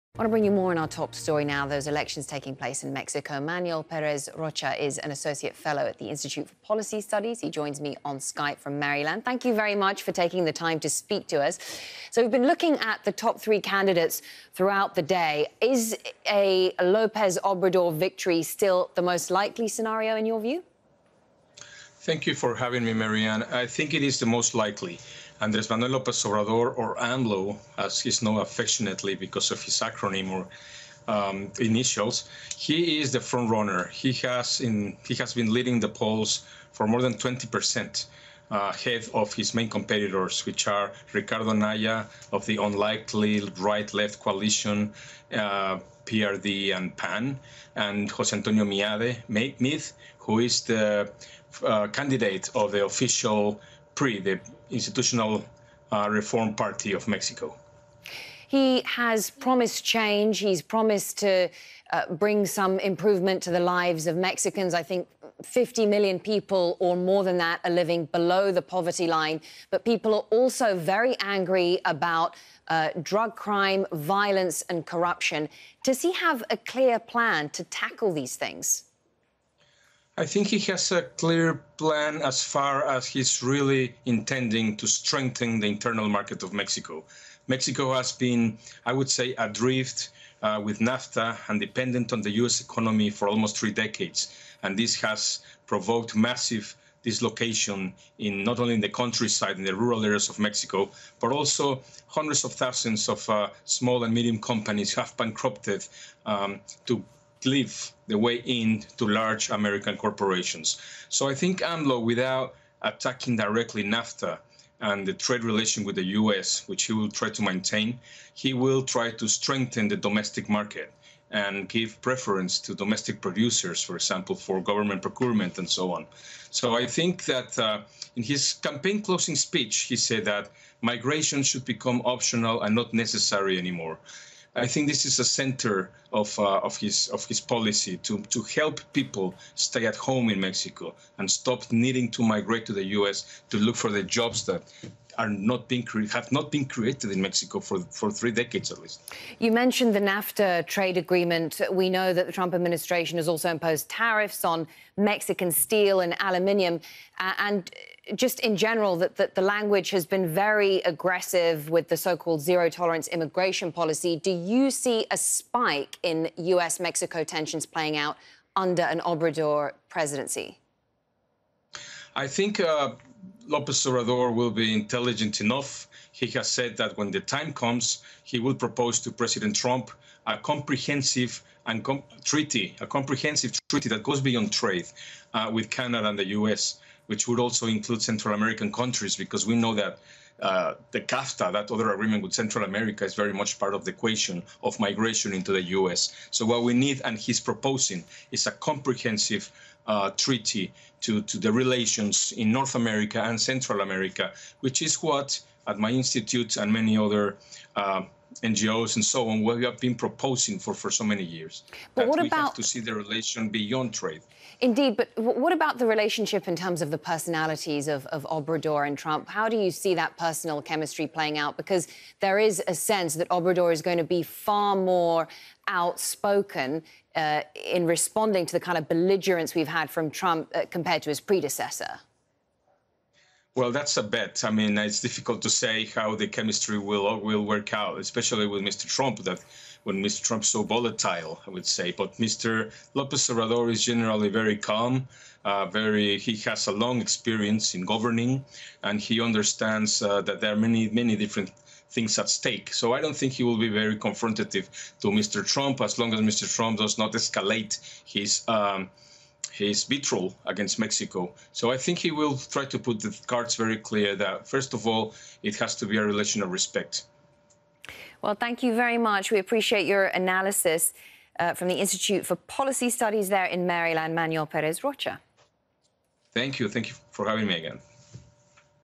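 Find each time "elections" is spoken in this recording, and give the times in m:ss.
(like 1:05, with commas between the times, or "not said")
0:01.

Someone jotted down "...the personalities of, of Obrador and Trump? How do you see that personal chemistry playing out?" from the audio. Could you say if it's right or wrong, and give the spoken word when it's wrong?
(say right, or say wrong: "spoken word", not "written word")
right.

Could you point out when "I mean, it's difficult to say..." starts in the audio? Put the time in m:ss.
3:54.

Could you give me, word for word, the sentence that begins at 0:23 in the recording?
I think it is the most likely.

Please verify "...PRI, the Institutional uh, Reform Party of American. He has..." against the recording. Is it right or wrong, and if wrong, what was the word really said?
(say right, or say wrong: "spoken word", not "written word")
wrong: "Mexico", not "American".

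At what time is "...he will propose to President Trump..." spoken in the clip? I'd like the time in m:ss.
2:58.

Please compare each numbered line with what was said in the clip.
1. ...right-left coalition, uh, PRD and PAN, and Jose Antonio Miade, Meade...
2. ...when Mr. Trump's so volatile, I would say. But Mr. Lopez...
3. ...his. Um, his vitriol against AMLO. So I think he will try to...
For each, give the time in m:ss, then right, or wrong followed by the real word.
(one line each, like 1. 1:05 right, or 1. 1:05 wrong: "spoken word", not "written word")
1. 0:43 right
2. 3:59 right
3. 4:18 wrong: "Mexico", not "AMLO".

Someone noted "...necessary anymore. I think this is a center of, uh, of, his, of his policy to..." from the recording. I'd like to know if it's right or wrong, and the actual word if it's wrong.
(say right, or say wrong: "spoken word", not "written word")
right.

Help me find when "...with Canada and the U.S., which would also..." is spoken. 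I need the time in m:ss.
3:05.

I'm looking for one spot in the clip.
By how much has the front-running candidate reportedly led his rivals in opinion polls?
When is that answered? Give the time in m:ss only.
0:36.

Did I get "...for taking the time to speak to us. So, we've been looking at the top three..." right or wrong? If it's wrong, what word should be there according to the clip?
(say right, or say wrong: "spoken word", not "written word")
right.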